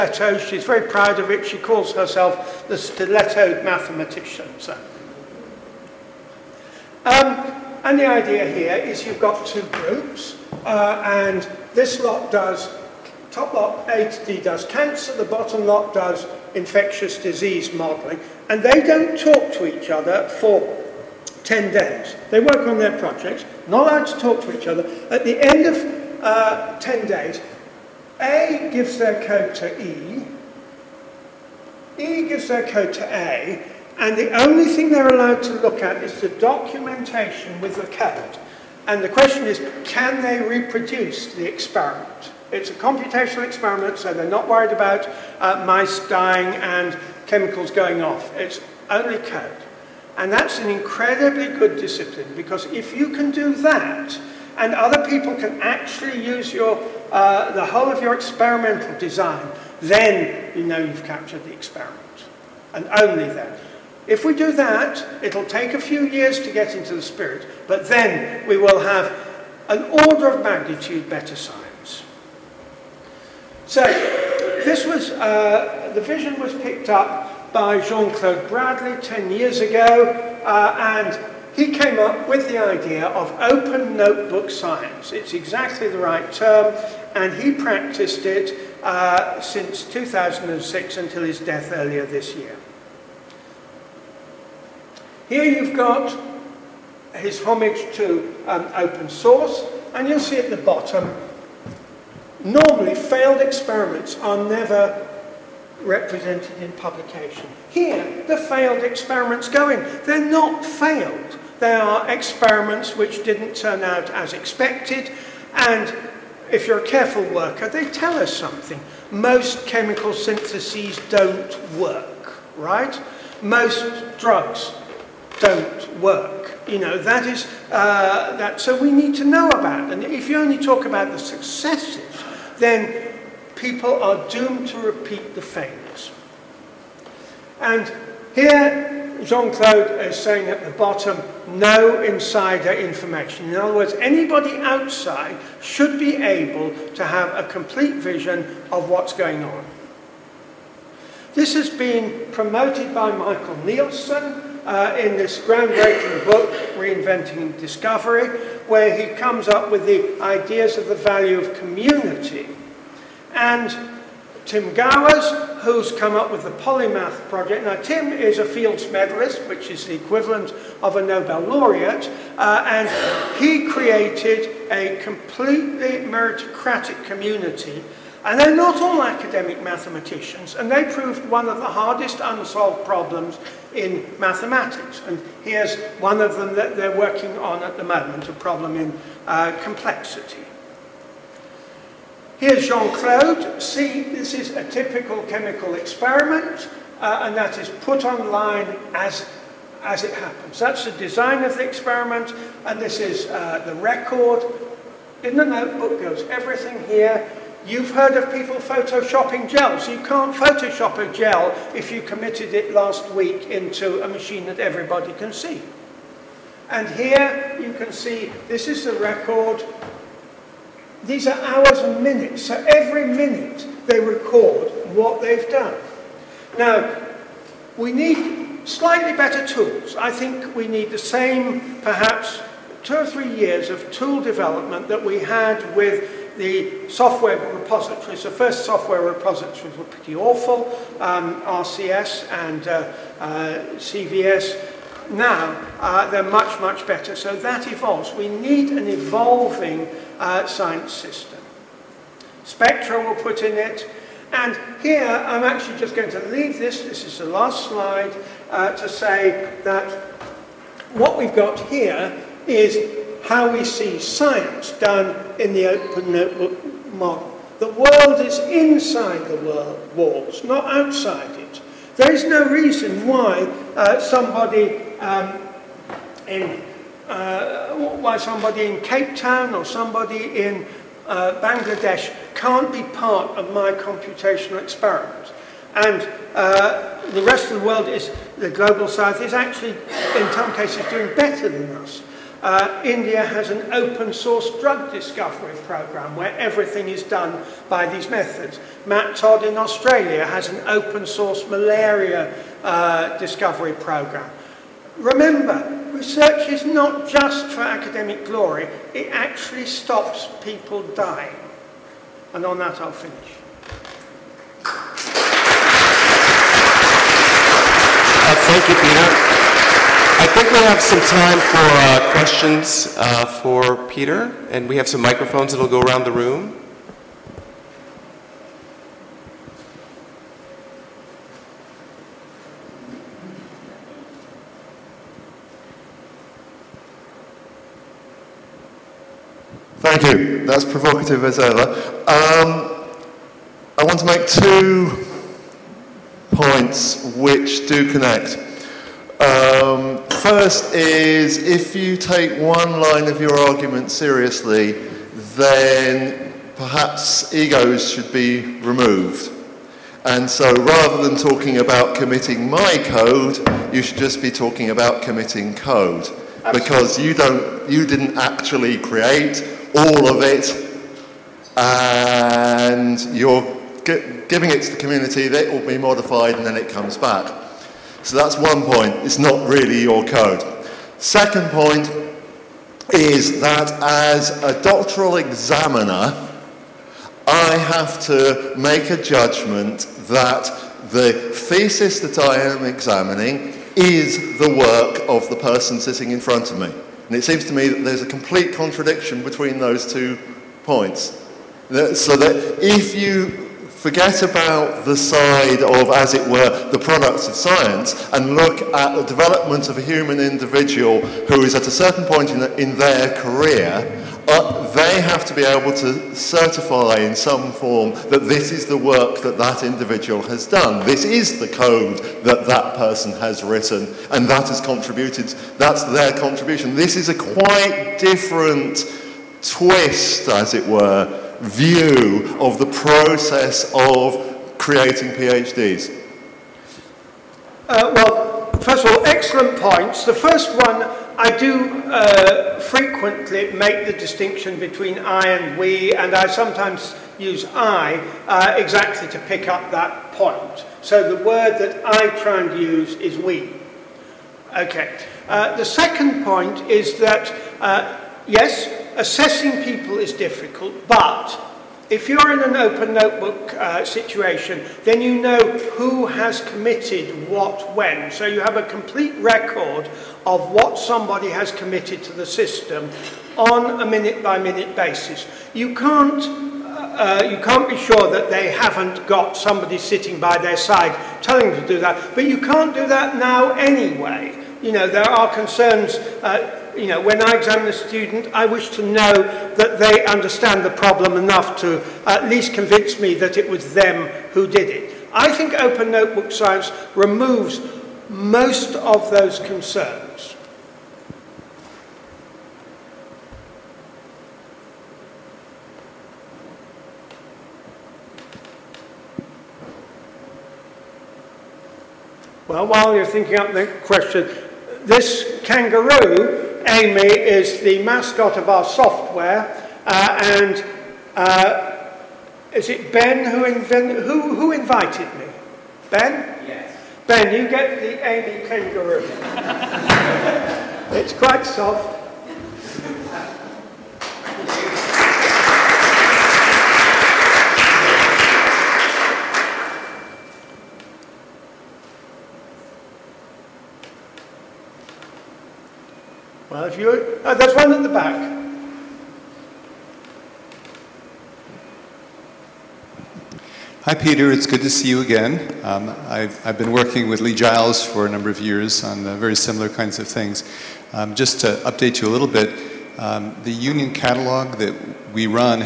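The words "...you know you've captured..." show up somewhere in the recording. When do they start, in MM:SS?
01:00.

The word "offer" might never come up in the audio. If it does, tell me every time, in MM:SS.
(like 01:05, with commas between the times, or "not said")
not said.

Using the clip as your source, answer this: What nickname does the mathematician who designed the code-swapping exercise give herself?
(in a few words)
the stiletto mathematician.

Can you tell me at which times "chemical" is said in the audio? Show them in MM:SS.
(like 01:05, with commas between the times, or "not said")
00:47, 01:59, 03:15.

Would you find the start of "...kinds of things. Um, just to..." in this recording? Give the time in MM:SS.
09:19.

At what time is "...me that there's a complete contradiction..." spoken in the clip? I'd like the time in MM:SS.
06:37.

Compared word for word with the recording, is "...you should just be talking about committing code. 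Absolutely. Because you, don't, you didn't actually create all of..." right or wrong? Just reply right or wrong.
right.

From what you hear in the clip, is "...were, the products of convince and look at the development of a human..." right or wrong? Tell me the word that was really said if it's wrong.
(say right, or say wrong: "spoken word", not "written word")
wrong: "science", not "convince".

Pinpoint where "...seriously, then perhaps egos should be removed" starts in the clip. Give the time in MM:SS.
05:53.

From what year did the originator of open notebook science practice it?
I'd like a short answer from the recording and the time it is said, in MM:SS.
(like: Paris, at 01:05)
2006, at 01:29.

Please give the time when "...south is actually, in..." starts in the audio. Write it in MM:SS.
04:48.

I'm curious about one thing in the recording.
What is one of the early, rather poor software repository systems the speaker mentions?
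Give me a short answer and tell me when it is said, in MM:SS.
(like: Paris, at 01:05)
RCS, at 04:01.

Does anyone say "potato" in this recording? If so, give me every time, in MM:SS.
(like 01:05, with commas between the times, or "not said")
not said.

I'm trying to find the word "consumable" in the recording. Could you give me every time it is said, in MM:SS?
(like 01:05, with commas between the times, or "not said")
not said.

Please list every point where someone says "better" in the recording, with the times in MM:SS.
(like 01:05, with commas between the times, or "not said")
01:11, 03:49, 04:06, 04:51.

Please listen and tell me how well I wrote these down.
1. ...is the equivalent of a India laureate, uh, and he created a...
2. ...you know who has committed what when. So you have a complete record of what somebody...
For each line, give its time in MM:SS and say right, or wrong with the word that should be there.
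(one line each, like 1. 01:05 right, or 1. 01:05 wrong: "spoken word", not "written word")
1. 02:49 wrong: "Nobel", not "India"
2. 07:45 right.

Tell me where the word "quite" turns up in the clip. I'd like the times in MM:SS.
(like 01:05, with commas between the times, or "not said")
07:07, 08:51.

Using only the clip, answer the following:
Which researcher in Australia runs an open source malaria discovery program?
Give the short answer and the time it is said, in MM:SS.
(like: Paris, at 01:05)
Matt Todd, at 04:58.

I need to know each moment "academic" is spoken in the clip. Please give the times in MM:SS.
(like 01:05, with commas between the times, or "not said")
02:59, 05:07.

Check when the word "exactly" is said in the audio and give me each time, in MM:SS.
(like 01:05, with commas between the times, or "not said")
01:25, 07:28.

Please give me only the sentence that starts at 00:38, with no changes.
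And the question is, can they reproduce the experiment?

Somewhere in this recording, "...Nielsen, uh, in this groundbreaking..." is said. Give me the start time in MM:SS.
02:33.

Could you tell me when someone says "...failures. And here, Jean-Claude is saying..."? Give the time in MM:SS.
02:15.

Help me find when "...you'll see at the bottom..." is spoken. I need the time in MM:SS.
01:40.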